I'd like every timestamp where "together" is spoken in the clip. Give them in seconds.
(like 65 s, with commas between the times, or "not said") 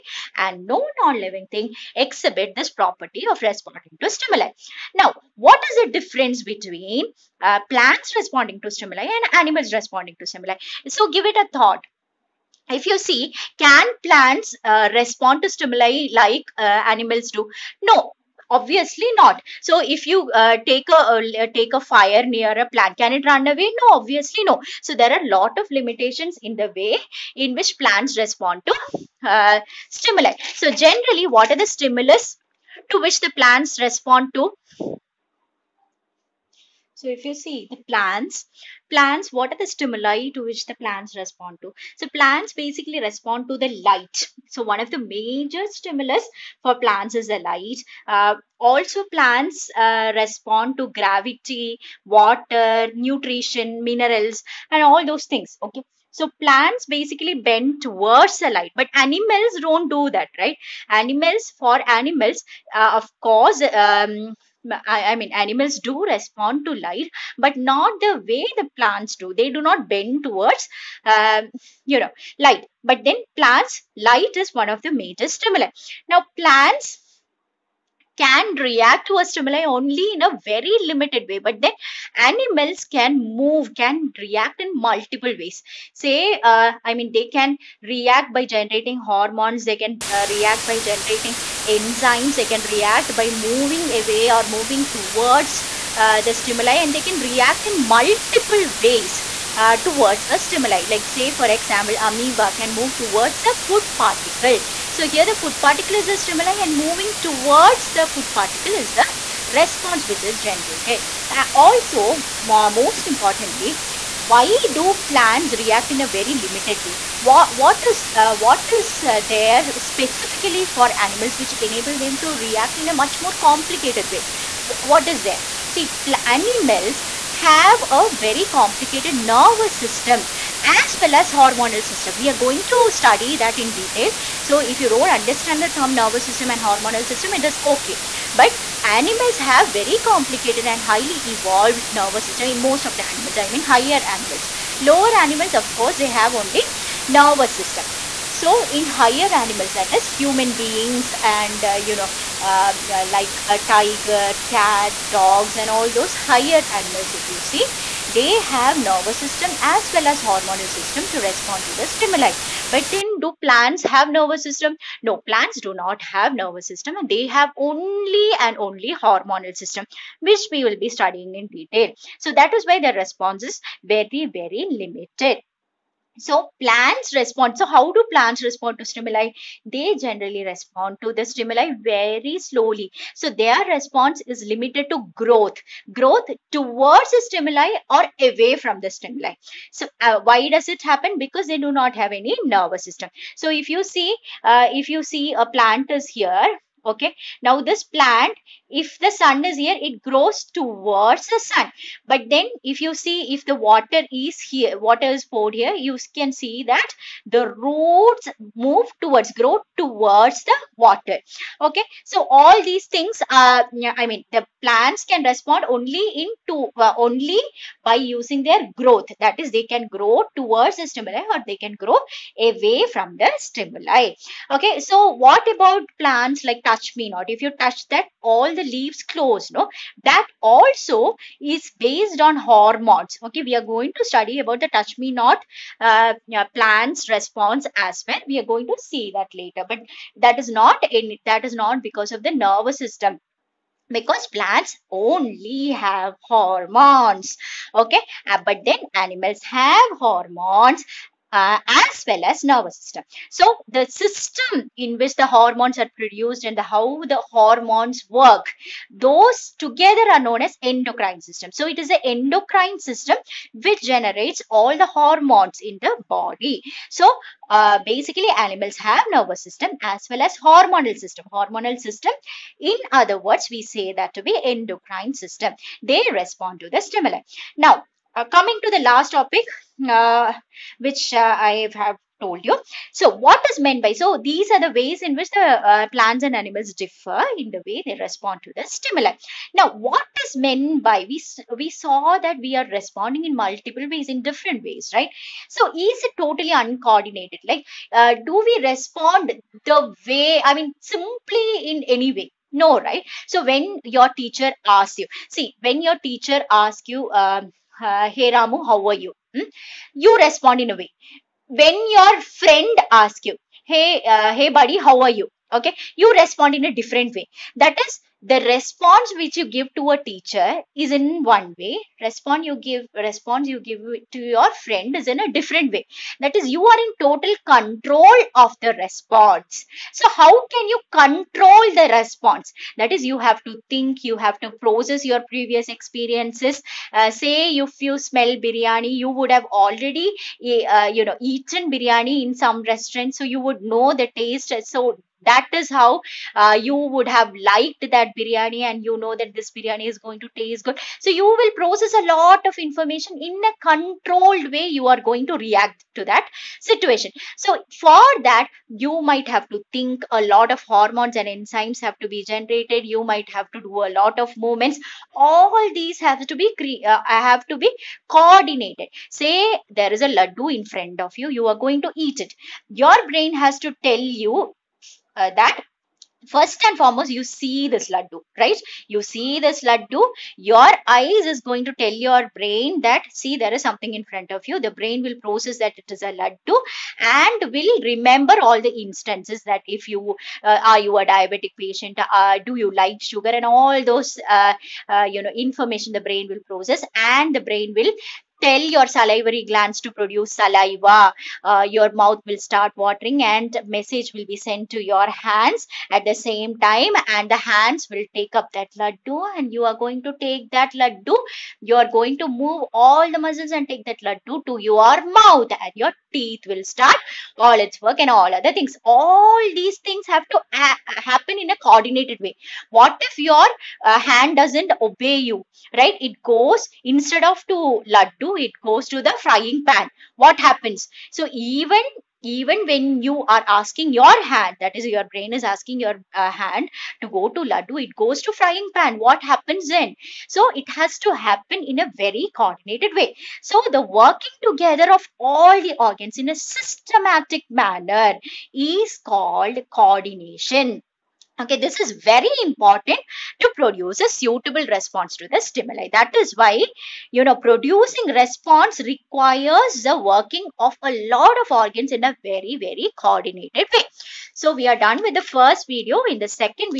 259 s, 444 s.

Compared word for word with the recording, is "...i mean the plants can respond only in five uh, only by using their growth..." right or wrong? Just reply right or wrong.
wrong.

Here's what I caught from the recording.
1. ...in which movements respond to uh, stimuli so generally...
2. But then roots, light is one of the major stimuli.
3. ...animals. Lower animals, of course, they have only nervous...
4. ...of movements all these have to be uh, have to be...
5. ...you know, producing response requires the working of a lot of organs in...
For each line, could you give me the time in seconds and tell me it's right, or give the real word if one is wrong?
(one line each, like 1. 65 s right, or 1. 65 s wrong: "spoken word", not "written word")
1. 27 s wrong: "plants", not "movements"
2. 72 s wrong: "plants", not "roots"
3. 144 s right
4. 364 s right
5. 457 s right.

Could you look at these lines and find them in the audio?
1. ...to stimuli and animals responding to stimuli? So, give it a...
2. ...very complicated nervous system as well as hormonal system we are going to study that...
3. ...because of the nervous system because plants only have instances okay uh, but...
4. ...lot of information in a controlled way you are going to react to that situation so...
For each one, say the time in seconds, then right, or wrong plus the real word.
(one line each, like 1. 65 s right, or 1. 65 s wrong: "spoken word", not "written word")
1. 8 s right
2. 128 s right
3. 241 s wrong: "hormones", not "instances"
4. 352 s right.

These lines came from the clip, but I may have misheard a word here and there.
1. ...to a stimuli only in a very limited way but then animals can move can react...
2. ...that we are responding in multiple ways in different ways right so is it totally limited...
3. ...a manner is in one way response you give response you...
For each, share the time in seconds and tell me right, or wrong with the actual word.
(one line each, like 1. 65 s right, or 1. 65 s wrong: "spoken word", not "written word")
1. 79 s right
2. 292 s wrong: "uncoordinated", not "limited"
3. 319 s wrong: "teacher", not "manner".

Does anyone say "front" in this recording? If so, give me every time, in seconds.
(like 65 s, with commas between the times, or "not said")
370 s, 384 s.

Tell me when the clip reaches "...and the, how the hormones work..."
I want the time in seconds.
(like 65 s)
256 s.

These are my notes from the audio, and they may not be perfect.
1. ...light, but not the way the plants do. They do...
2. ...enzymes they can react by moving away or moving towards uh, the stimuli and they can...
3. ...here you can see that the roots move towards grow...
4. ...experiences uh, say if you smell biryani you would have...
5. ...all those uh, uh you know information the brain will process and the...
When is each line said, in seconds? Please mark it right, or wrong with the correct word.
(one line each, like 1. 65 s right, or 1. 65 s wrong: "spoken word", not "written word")
1. 66 s right
2. 91 s right
3. 205 s right
4. 335 s right
5. 393 s right.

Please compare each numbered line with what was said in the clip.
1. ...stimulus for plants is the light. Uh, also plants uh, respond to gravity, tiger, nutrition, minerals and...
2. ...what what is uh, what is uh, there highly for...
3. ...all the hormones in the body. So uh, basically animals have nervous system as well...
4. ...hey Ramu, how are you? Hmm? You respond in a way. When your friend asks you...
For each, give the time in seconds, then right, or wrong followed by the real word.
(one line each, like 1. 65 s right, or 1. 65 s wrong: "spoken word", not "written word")
1. 45 s wrong: "water", not "tiger"
2. 117 s wrong: "specifically", not "highly"
3. 264 s right
4. 308 s right.